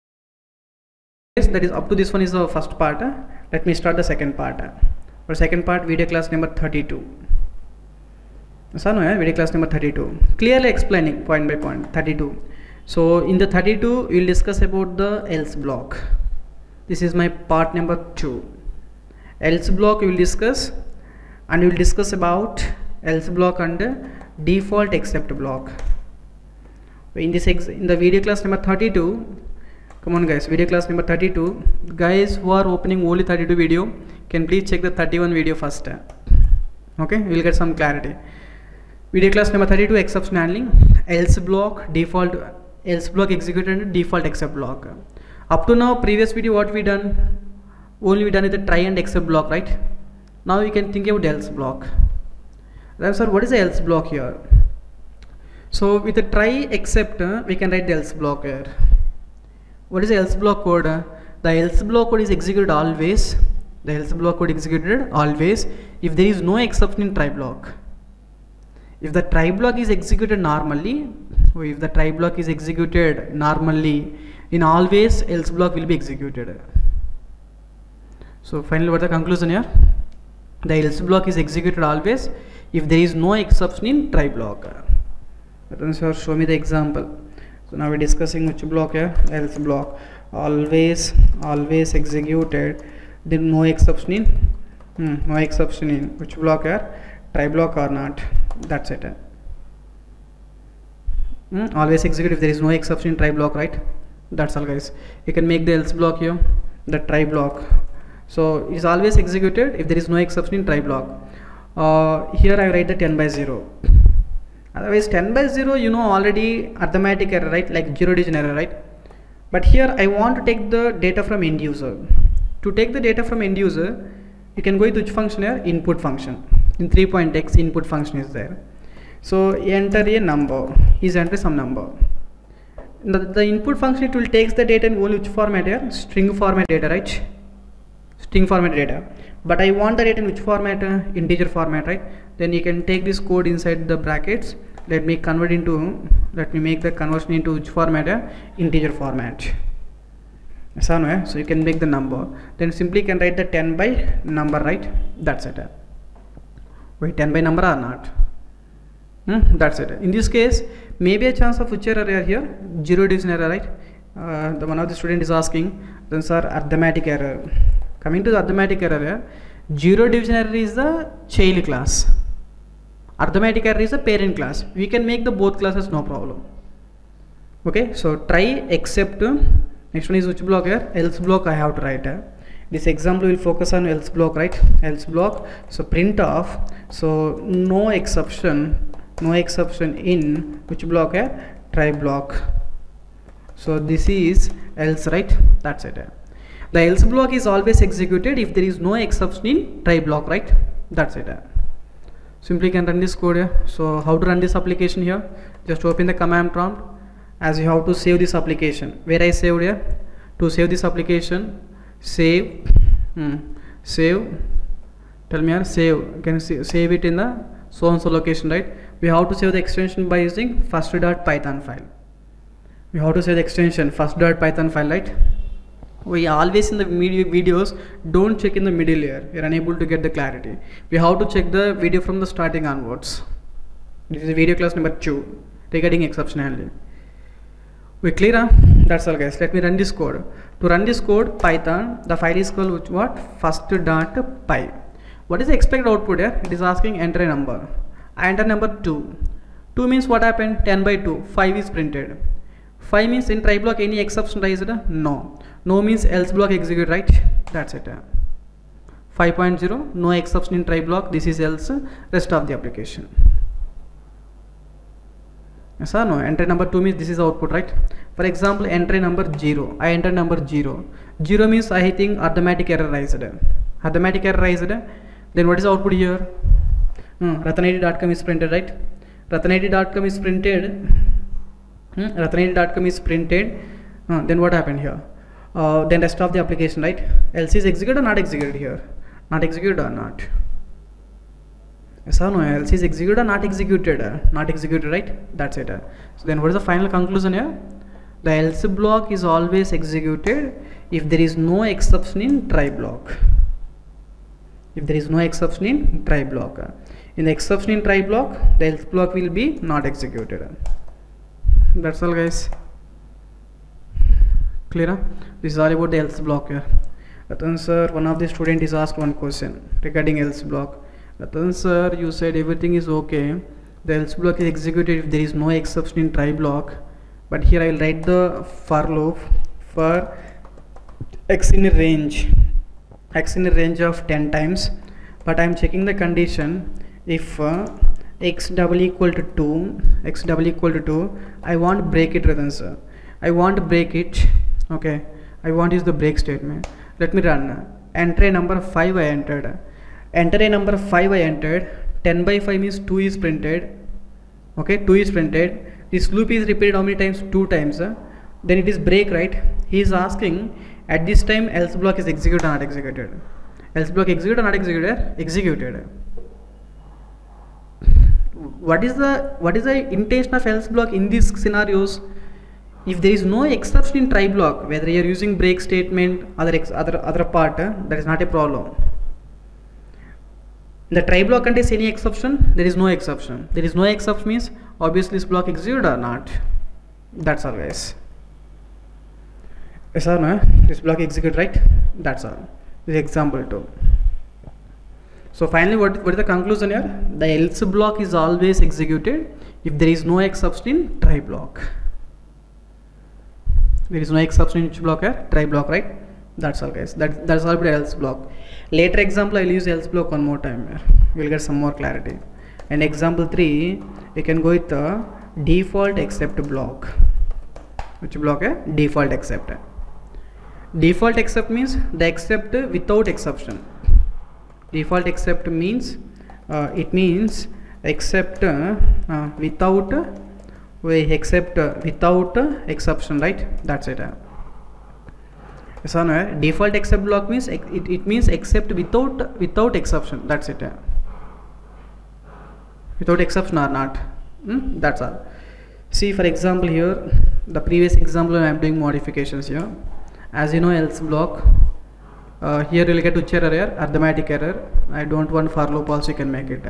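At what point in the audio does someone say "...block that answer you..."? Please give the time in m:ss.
5:20.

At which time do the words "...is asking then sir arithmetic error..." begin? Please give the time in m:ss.
2:45.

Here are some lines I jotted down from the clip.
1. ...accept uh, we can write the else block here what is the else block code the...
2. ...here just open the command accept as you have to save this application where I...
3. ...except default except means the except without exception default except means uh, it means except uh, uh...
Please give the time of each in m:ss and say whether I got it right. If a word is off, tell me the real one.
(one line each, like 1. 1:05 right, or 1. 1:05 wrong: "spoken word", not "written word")
1. 0:56 wrong: "except", not "accept"
2. 3:25 wrong: "prompt", not "accept"
3. 6:59 right.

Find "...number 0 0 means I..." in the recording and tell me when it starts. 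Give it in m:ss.
4:30.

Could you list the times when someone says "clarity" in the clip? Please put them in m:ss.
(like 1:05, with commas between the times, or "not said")
0:37, 3:50, 6:51.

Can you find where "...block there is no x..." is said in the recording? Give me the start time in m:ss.
6:41.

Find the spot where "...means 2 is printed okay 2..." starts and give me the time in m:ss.
5:52.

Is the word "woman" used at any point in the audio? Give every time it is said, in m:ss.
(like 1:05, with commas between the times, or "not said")
not said.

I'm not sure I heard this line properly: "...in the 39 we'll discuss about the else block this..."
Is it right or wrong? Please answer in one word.
wrong.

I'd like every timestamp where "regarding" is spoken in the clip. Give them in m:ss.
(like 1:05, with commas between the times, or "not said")
3:55, 5:19.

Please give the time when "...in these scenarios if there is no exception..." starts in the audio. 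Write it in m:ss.
6:10.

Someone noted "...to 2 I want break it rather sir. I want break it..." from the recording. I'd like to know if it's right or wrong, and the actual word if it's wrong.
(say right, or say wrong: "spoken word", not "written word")
right.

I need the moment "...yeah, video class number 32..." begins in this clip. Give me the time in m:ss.
0:09.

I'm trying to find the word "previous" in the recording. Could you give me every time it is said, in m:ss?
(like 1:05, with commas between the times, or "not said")
0:46, 7:27.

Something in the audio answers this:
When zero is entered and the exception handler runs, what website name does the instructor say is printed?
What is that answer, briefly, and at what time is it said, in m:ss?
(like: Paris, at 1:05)
ratanit.com, at 4:39.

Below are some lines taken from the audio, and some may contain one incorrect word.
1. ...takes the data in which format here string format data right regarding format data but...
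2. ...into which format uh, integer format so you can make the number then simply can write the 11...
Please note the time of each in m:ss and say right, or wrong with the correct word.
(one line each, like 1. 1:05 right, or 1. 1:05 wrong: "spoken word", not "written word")
1. 2:14 wrong: "string", not "regarding"
2. 2:27 wrong: "10", not "11".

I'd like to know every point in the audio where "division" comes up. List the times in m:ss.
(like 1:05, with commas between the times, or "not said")
2:43, 2:50.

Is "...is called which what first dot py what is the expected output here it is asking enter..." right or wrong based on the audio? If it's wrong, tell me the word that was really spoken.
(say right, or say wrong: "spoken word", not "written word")
right.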